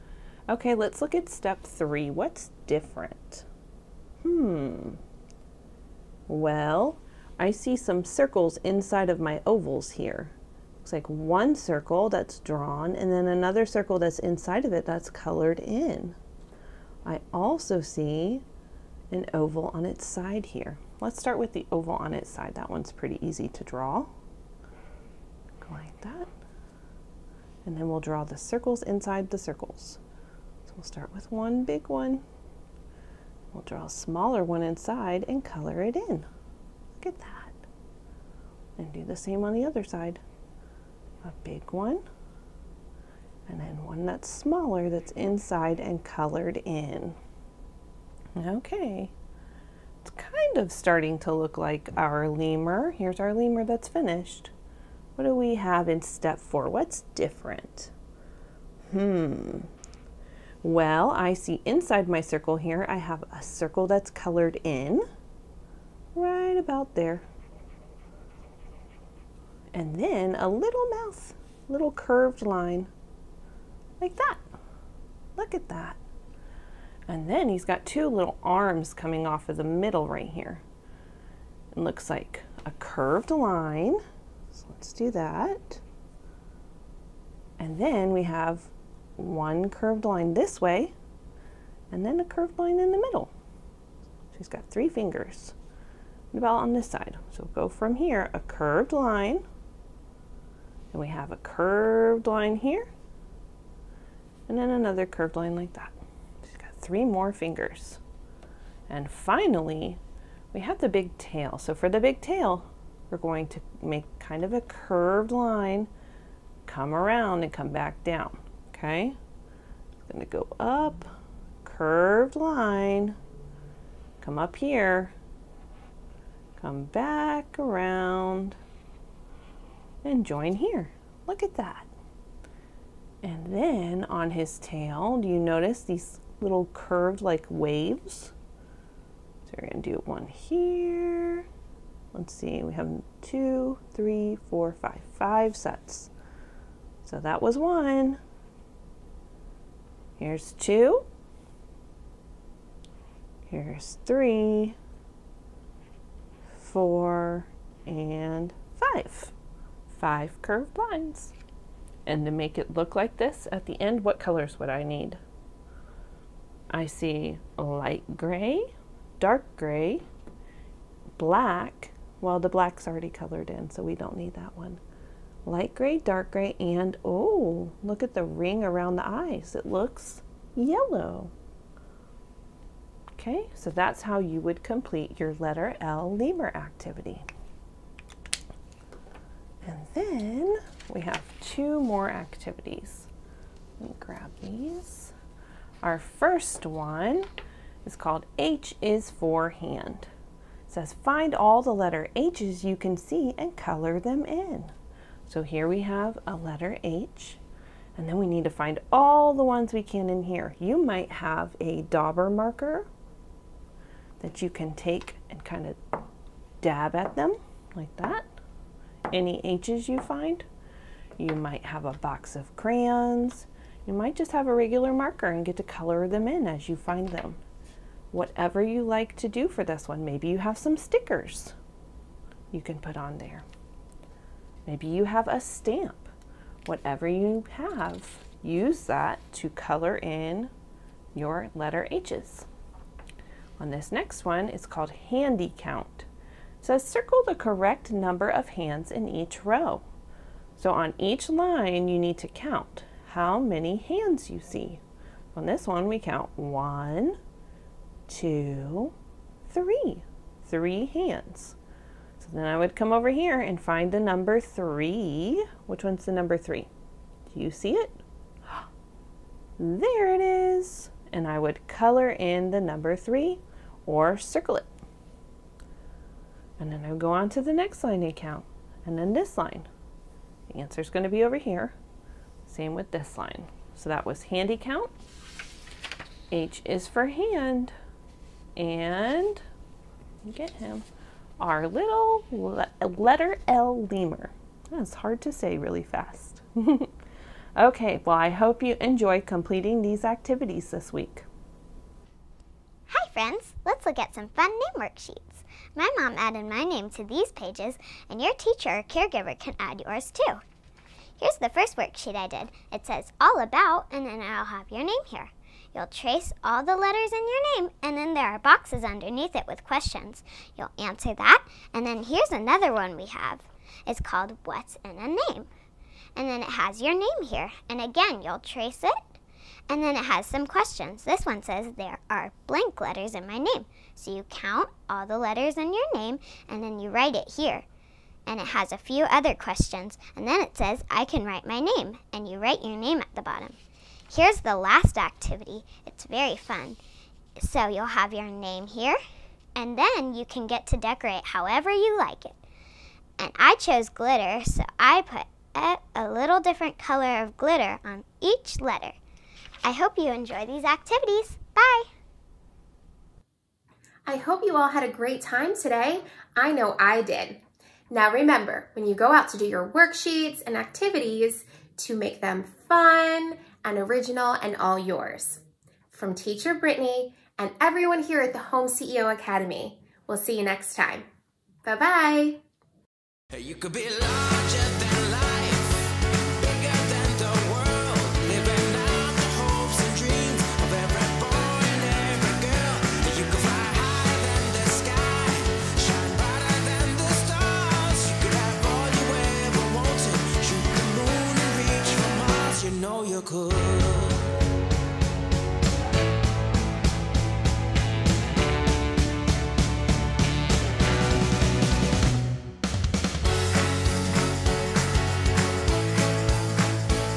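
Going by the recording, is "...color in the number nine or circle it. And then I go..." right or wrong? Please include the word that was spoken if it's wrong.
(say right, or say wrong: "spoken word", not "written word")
wrong: "three", not "nine".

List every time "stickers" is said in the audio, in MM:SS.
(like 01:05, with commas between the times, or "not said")
03:50.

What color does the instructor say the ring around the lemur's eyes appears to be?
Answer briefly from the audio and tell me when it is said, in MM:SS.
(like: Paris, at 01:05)
Yellow, at 03:00.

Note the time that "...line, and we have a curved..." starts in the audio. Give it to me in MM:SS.
01:38.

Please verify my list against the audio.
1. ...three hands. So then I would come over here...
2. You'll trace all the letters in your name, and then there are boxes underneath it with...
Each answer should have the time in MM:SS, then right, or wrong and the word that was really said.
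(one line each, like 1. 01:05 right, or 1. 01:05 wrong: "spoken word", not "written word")
1. 04:20 right
2. 05:15 right.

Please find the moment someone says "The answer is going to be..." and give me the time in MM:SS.
04:40.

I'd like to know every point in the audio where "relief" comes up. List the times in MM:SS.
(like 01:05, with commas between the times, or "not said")
not said.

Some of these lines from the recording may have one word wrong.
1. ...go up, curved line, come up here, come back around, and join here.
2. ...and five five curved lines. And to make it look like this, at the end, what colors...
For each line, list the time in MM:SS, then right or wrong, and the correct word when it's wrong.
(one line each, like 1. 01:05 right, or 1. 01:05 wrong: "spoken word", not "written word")
1. 02:00 right
2. 02:37 right.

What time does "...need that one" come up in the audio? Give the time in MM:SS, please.
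02:54.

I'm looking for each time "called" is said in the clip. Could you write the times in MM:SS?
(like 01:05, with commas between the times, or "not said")
03:17, 04:04, 05:23.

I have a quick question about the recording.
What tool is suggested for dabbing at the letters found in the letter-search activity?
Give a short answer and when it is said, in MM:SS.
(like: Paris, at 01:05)
Dauber marker, at 03:31.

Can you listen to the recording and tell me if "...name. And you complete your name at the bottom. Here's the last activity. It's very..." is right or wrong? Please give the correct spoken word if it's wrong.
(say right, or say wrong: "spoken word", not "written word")
wrong: "write", not "complete".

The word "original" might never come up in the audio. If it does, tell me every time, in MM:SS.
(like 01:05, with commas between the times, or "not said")
06:13.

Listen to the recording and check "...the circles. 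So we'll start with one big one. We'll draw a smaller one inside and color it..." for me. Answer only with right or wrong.
right.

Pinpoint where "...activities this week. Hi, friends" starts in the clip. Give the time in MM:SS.
05:00.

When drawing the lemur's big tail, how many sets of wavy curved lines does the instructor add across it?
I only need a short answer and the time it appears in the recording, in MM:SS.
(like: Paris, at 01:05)
5, at 02:25.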